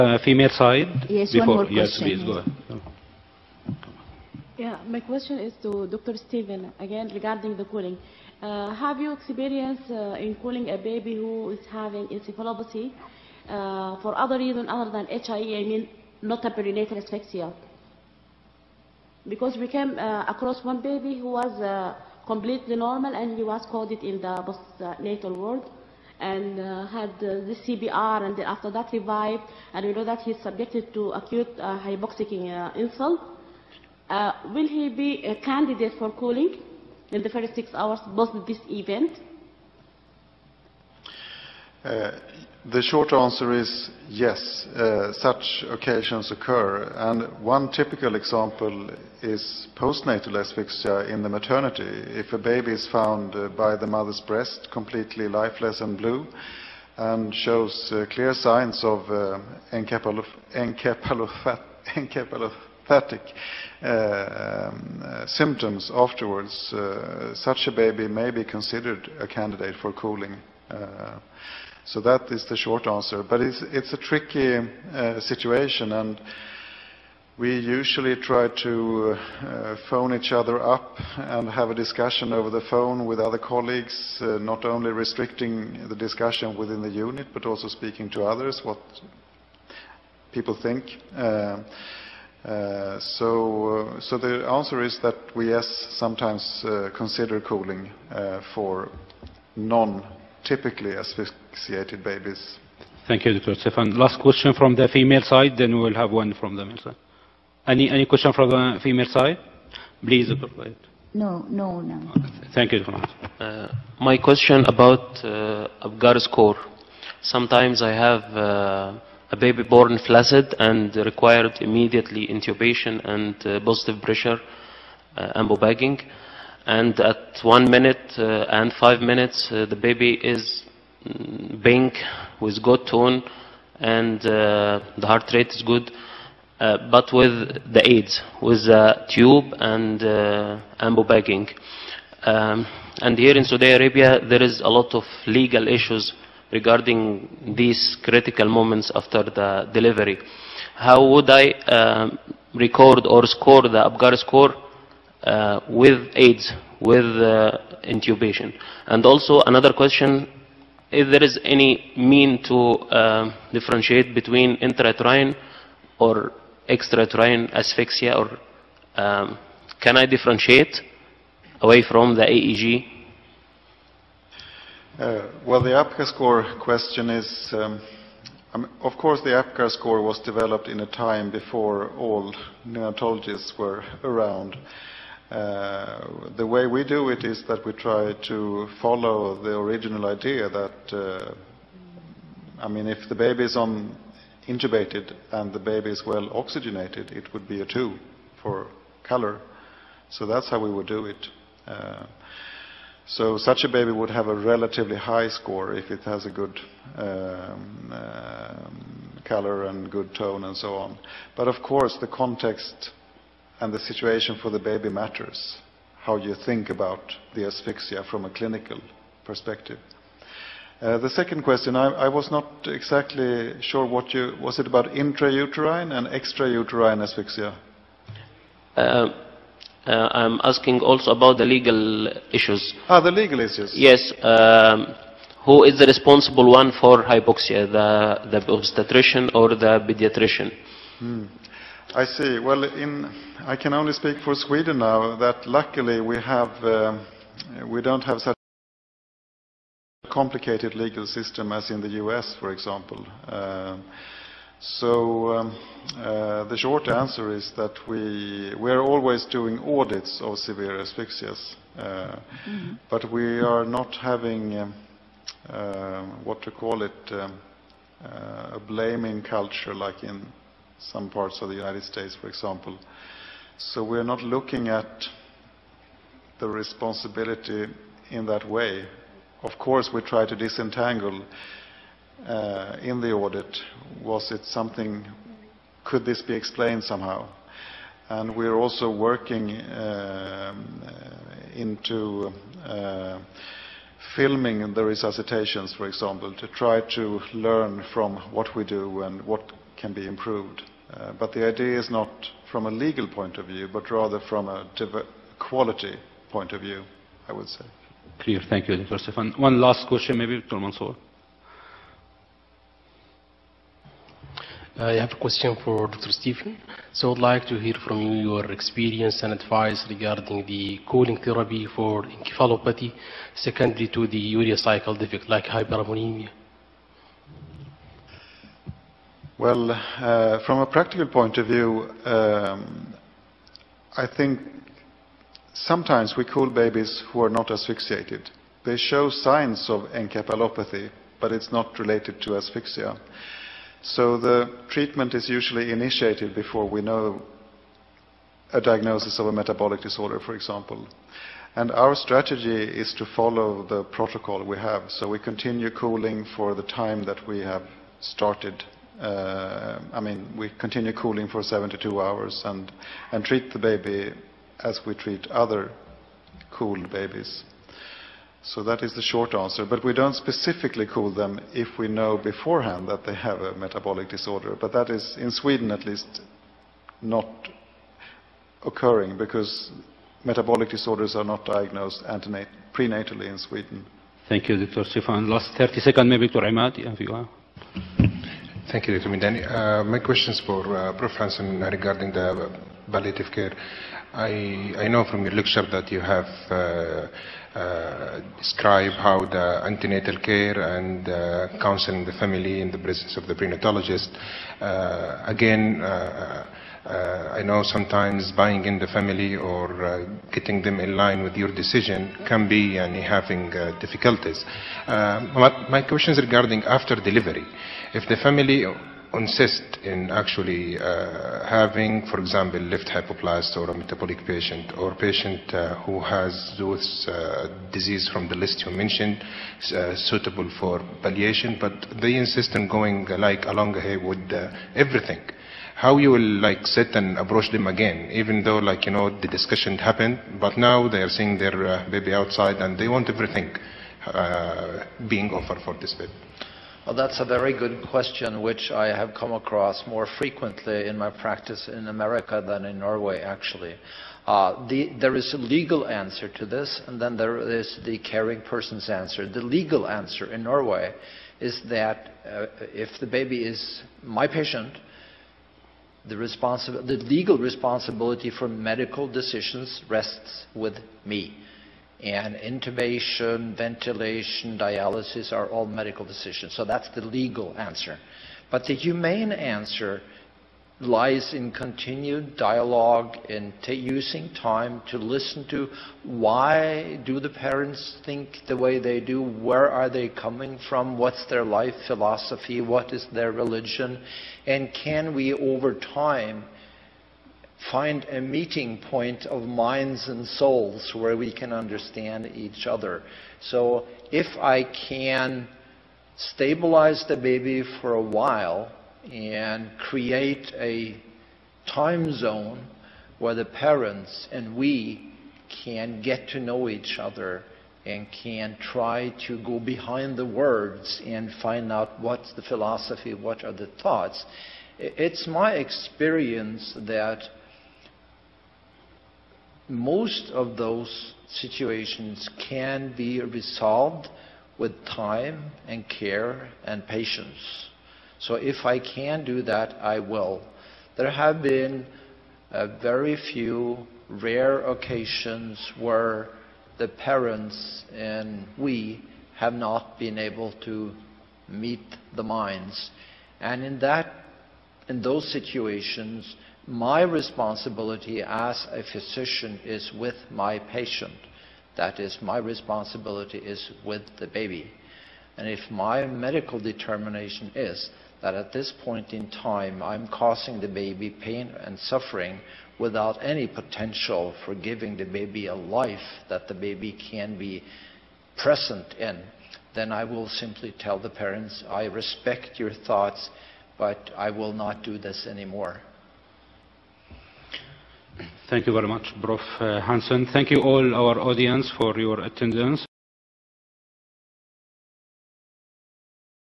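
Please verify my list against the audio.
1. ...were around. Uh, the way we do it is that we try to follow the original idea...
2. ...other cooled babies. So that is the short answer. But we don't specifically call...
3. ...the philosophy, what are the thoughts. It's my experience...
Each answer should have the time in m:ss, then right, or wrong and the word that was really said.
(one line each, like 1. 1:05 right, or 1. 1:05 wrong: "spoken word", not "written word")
1. 3:03 right
2. 6:05 right
3. 8:42 right.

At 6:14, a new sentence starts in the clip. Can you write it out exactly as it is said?
But that is, in Sweden at least, not occurring because metabolic disorders are not diagnosed prenatally in Sweden.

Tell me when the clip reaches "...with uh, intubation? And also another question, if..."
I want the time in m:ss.
2:36.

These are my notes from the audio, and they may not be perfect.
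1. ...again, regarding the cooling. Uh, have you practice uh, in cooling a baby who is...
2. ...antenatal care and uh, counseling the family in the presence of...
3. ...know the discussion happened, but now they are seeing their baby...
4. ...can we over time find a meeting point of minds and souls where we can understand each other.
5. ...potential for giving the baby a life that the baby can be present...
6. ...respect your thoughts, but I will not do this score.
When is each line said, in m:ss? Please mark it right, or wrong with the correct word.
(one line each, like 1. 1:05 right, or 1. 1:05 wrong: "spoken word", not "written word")
1. 0:06 wrong: "experience", not "practice"
2. 6:39 right
3. 7:18 right
4. 8:14 right
5. 9:33 right
6. 9:41 wrong: "anymore", not "score".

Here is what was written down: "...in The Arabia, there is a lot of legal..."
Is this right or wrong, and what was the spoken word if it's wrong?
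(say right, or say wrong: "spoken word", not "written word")
wrong: "Saudi", not "The".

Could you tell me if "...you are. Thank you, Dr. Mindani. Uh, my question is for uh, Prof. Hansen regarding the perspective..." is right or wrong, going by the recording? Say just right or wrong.
wrong.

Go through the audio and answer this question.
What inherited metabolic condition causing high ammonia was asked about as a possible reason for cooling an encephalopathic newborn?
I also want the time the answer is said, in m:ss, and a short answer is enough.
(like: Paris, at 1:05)
Urea cycle defect, at 5:24.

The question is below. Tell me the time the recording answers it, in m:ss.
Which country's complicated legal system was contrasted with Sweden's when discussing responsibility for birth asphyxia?
4:11.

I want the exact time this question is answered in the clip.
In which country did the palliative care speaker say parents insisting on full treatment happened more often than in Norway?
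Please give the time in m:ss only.
7:31.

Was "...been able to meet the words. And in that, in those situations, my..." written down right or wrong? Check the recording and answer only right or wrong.
wrong.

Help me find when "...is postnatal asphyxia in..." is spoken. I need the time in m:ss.
0:49.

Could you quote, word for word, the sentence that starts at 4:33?
So we're not looking at the responsibility in that way.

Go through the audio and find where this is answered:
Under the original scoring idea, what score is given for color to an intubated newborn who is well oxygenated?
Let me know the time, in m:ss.
3:17.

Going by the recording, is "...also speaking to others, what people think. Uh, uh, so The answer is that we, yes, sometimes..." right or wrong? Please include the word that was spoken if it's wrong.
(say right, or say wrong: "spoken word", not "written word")
right.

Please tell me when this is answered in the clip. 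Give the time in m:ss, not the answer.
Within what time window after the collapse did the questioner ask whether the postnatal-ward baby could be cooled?
0:37.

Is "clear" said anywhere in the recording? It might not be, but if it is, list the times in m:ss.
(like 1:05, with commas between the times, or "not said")
0:58, 5:08.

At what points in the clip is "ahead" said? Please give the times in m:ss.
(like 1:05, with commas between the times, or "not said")
0:02.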